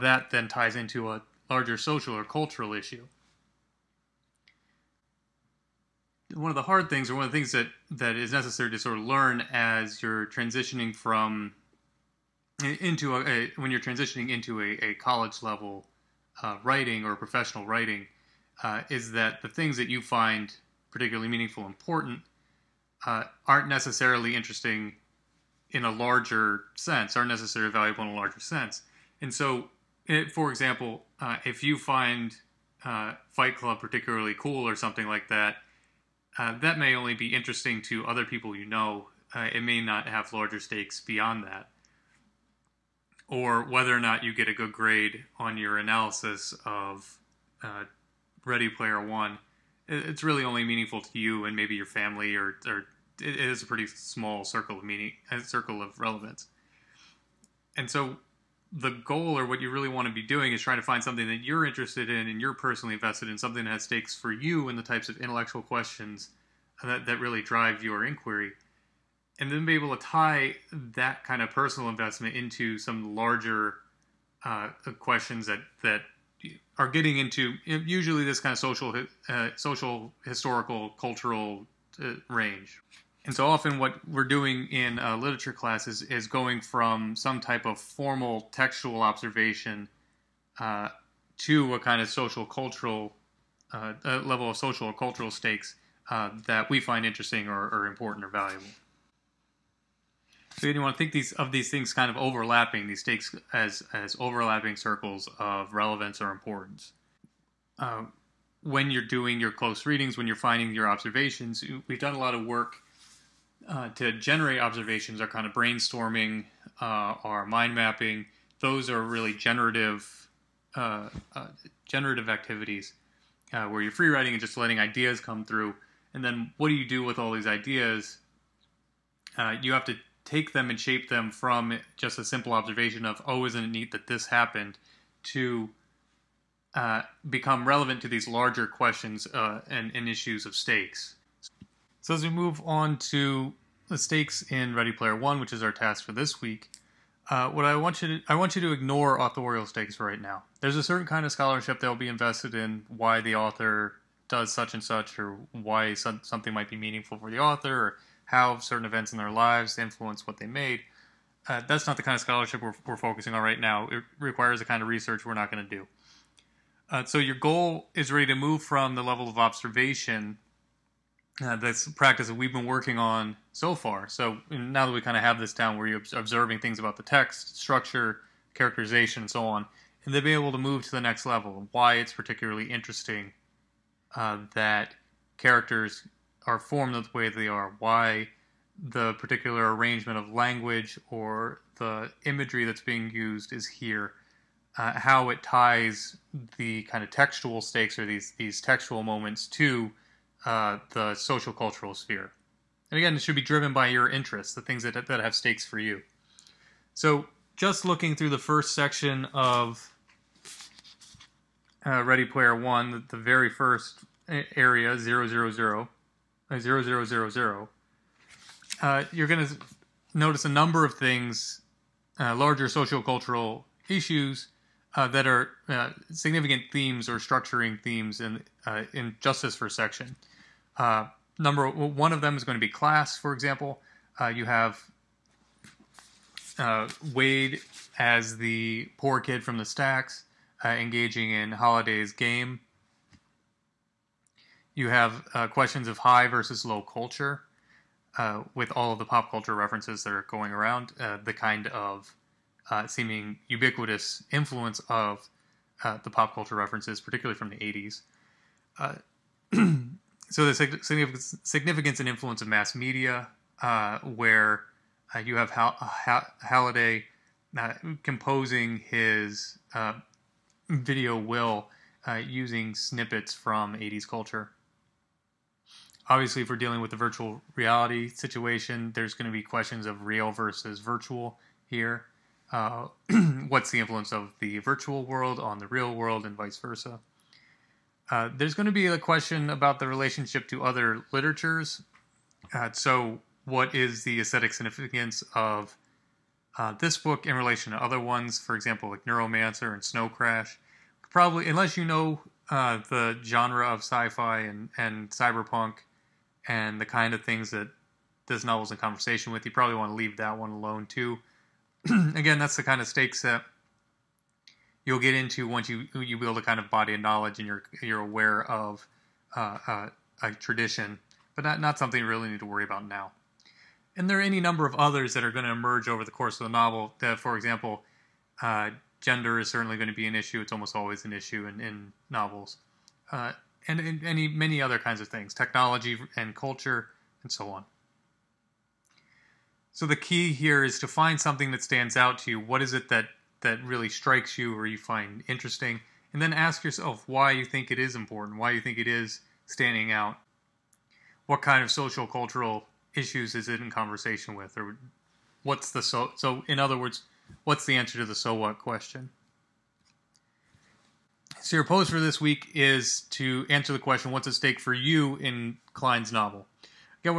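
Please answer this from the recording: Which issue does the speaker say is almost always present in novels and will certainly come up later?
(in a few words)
Gender.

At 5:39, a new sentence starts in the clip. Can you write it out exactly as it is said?
So the key here is to find something that stands out to you.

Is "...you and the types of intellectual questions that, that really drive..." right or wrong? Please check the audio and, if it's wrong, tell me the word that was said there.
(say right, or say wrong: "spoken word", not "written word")
right.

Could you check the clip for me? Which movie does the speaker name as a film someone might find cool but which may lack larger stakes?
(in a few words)
Fight Club.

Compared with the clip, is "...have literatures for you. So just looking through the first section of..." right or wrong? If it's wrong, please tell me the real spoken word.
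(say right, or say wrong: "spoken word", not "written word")
wrong: "stakes", not "literatures".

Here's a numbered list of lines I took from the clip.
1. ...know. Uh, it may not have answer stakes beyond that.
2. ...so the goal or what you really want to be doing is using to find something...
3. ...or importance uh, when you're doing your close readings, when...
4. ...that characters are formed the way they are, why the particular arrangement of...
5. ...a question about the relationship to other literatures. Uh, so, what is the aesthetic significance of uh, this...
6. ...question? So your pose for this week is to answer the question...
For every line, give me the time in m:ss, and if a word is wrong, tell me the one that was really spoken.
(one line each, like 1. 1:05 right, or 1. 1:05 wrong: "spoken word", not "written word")
1. 0:38 wrong: "larger", not "answer"
2. 0:57 wrong: "trying", not "using"
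3. 1:46 right
4. 3:04 right
5. 4:48 right
6. 5:58 right.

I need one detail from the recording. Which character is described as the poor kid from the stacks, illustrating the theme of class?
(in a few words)
Wade.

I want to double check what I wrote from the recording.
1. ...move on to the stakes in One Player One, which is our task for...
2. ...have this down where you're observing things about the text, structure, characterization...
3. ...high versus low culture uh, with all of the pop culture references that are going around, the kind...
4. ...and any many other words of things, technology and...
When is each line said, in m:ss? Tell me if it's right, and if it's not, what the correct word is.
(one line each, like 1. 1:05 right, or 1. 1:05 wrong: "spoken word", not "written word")
1. 2:22 wrong: "Ready", not "One"
2. 2:55 right
3. 4:05 right
4. 5:33 wrong: "kinds", not "words".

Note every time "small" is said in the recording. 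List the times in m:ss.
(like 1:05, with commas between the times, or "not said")
0:53.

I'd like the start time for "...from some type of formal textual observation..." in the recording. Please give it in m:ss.
1:26.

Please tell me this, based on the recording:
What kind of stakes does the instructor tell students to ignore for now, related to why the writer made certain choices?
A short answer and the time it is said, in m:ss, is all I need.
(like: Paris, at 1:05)
Authorial stakes, at 2:29.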